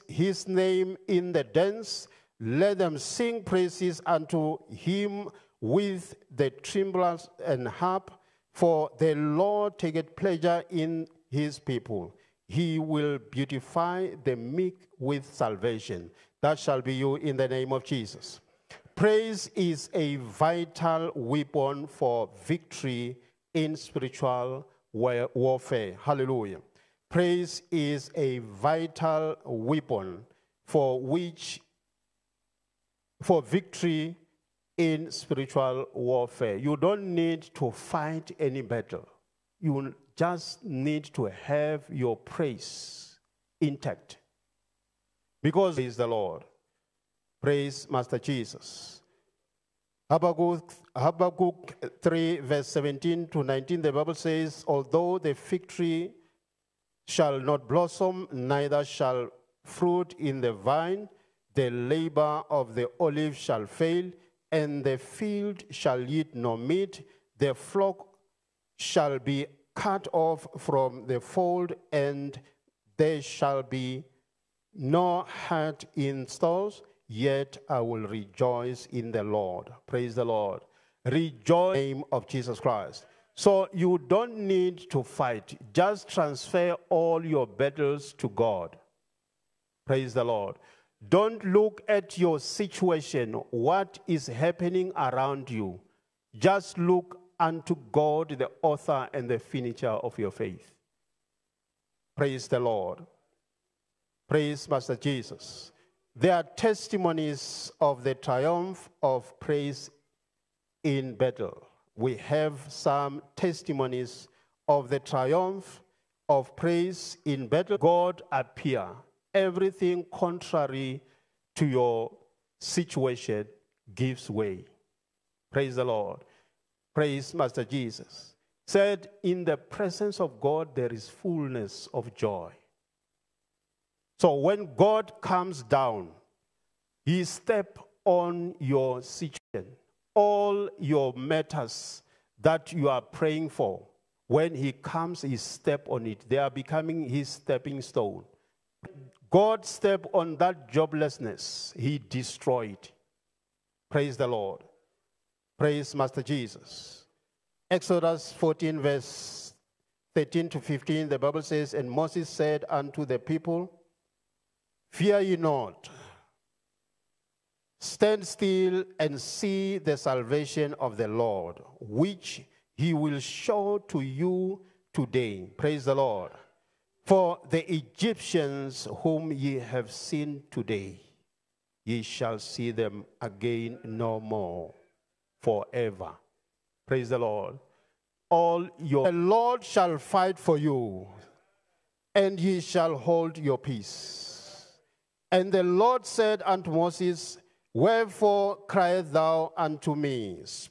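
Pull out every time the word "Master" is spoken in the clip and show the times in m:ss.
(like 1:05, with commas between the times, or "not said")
0:47, 1:44, 2:07, 2:35.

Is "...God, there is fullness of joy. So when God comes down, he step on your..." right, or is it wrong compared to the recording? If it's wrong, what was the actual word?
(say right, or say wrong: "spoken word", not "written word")
right.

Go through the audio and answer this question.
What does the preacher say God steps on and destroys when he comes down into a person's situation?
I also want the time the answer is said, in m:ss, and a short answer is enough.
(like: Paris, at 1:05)
Joblessness, at 2:30.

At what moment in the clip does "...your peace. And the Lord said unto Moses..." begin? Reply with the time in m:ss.
3:13.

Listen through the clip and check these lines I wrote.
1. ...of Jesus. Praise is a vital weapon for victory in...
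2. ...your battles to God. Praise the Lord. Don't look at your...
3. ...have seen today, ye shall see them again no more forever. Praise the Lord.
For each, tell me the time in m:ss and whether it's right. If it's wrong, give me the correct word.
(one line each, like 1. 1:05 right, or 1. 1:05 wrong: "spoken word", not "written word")
1. 0:17 right
2. 1:27 right
3. 2:59 right.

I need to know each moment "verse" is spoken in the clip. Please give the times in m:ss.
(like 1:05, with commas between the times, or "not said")
0:52, 2:38.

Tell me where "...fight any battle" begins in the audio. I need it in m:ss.
0:37.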